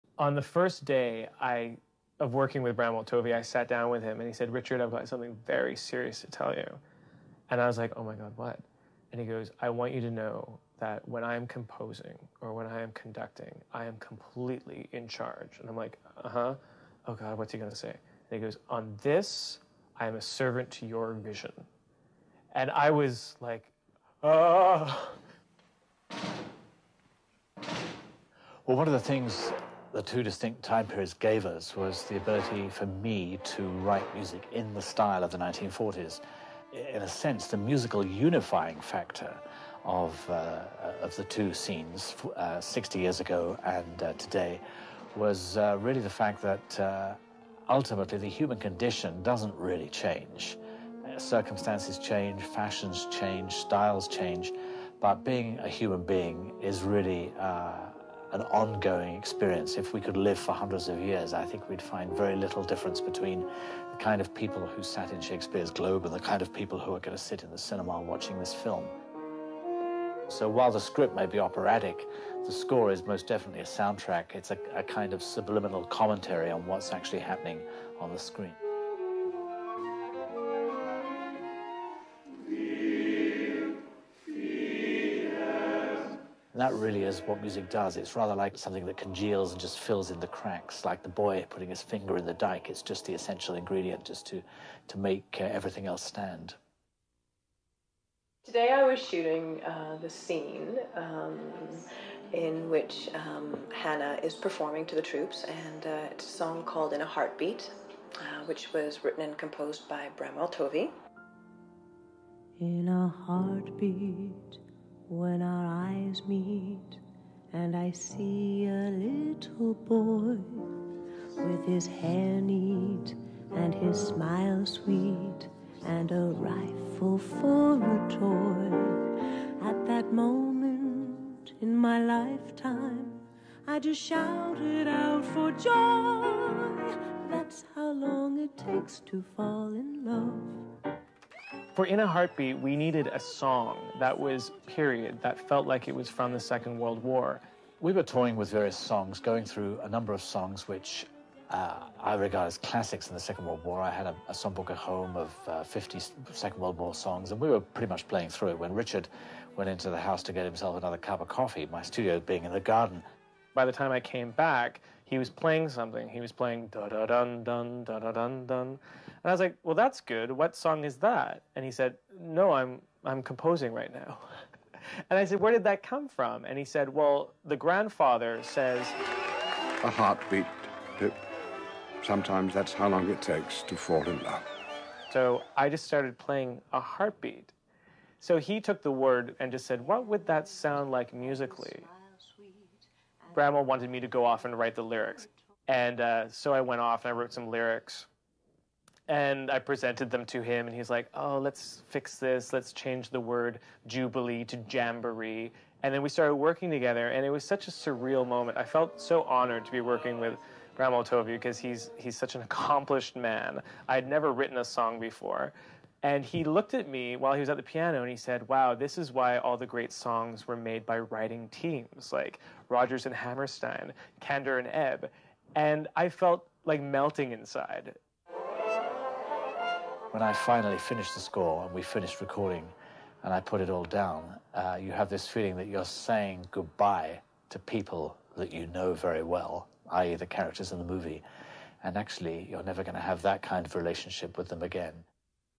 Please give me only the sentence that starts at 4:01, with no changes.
And actually, you're never going to have that kind of relationship with them again.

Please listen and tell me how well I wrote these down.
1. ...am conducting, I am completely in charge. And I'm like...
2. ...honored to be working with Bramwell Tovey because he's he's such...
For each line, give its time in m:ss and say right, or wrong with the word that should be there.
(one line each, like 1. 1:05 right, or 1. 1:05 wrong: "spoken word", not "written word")
1. 0:12 right
2. 3:29 right.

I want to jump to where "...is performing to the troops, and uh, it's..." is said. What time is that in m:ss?
1:44.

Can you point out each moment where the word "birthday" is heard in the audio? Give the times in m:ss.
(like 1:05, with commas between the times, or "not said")
not said.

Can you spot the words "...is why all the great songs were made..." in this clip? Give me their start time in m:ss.
3:38.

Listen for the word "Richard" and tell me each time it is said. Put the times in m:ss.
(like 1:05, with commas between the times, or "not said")
0:04, 2:38.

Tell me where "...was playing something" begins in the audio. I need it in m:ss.
2:45.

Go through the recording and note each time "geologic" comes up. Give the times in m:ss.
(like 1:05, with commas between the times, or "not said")
not said.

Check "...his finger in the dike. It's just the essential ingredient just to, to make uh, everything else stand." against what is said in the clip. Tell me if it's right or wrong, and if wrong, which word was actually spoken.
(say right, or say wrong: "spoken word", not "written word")
right.